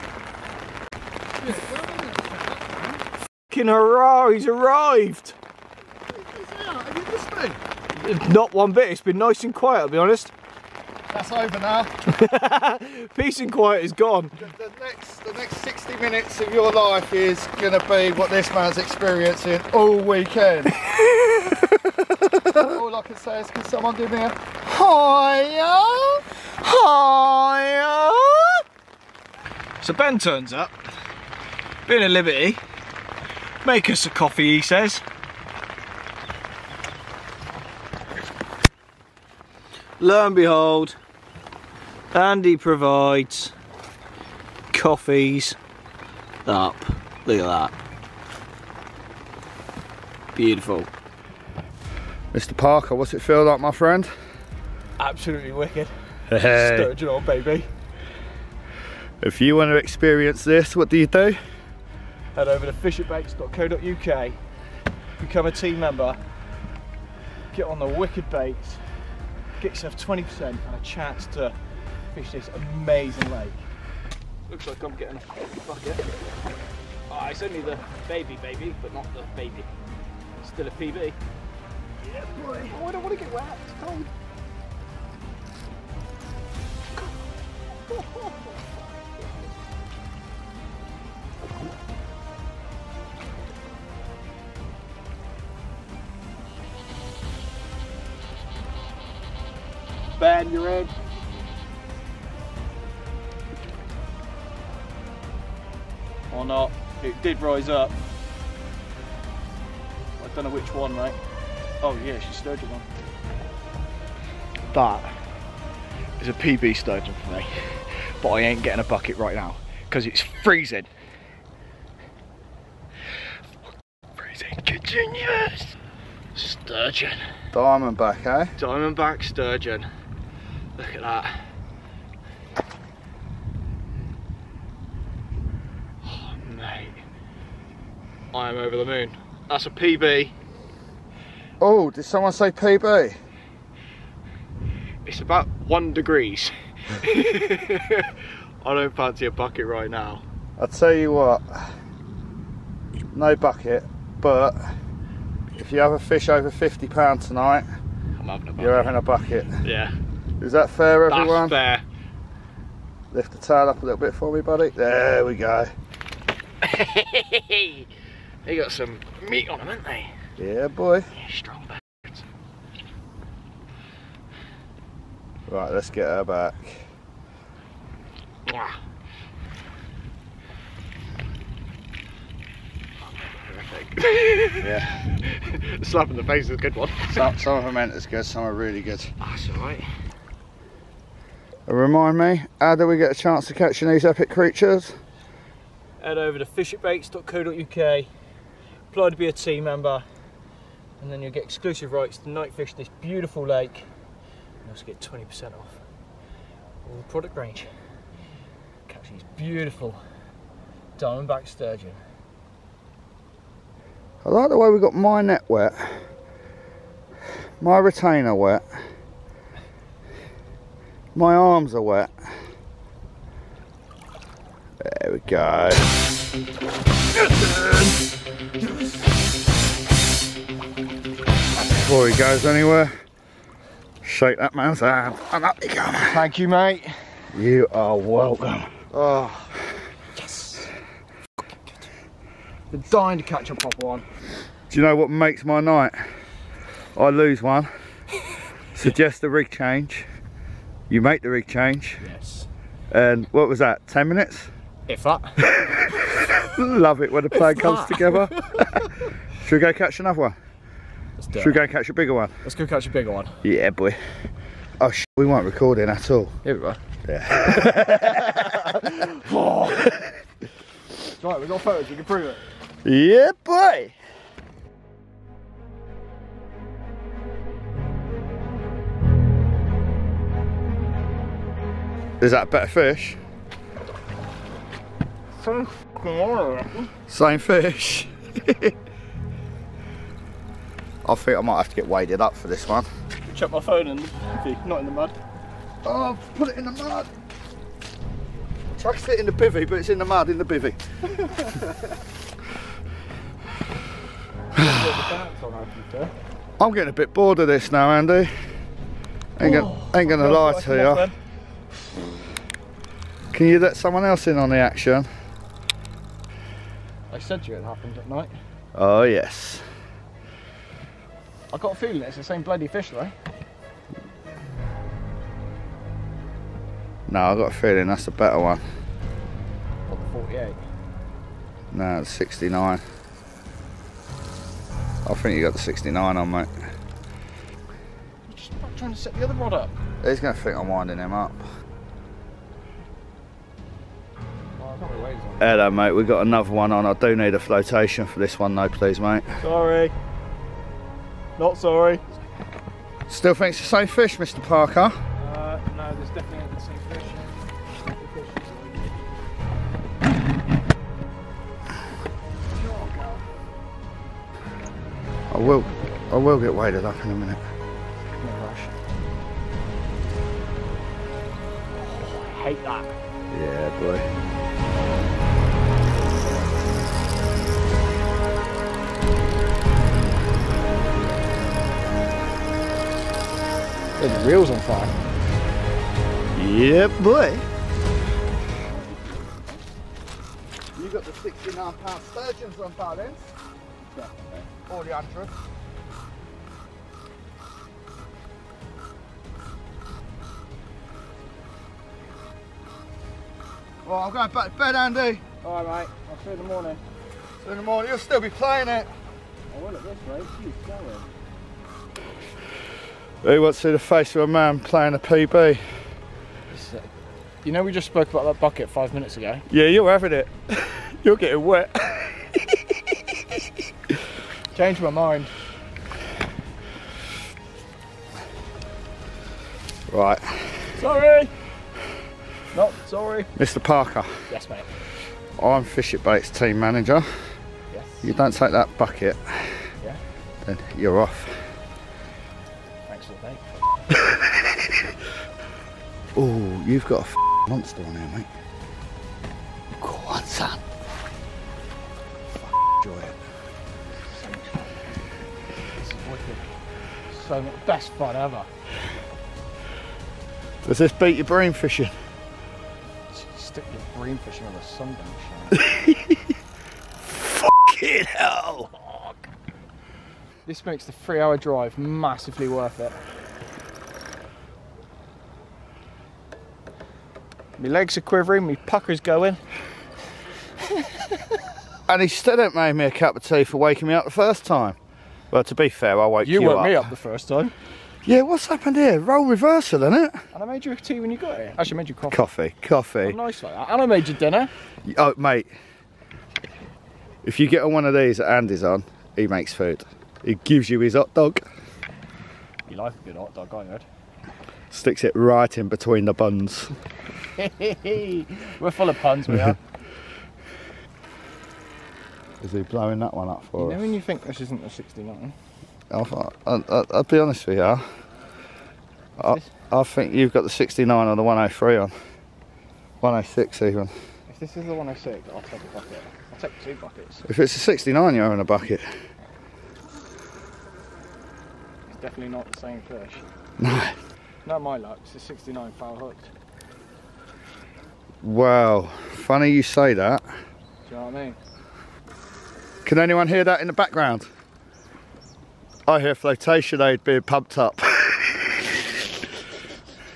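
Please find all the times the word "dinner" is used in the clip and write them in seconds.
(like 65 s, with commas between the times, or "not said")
494 s.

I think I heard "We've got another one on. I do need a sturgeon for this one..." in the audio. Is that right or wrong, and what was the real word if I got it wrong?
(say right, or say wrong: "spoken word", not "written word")
wrong: "flotation", not "sturgeon".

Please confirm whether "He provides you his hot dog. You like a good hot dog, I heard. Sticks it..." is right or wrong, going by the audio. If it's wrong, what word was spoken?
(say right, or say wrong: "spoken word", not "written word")
wrong: "gives", not "provides".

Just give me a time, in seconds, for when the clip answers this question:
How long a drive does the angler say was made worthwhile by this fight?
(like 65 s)
470 s.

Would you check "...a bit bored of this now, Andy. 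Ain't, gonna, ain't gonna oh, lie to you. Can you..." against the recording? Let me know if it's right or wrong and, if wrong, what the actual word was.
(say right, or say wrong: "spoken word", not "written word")
right.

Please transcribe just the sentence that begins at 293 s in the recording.
Check my phone in, not in the mud.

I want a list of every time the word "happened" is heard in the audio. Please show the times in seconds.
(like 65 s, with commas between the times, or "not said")
317 s, 488 s.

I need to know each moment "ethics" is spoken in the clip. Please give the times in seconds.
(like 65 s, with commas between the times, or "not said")
not said.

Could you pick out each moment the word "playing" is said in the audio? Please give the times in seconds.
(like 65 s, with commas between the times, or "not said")
408 s, 414 s.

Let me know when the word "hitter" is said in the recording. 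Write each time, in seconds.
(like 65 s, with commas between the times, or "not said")
not said.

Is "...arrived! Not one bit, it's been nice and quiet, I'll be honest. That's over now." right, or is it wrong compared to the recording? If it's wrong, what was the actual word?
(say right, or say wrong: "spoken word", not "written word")
right.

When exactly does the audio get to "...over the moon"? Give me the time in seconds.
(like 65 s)
138 s.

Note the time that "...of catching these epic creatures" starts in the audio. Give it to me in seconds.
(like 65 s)
193 s.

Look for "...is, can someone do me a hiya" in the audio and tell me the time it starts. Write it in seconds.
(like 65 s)
23 s.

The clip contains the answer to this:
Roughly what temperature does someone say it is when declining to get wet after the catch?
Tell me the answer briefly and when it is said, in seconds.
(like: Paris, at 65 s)
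1 degree, at 145 s.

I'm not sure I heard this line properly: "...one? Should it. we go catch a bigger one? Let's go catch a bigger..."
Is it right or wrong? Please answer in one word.
right.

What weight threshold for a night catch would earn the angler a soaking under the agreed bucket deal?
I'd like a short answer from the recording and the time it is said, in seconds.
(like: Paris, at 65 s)
50 pound, at 156 s.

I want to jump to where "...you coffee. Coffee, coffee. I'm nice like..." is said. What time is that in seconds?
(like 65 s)
491 s.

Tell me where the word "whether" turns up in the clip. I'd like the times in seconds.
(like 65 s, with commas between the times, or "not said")
not said.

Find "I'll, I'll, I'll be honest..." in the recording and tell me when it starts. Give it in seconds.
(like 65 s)
515 s.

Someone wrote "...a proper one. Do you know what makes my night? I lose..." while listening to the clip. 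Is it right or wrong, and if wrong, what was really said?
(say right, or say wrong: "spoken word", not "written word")
right.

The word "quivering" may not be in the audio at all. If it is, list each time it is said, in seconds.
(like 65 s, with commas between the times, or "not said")
478 s.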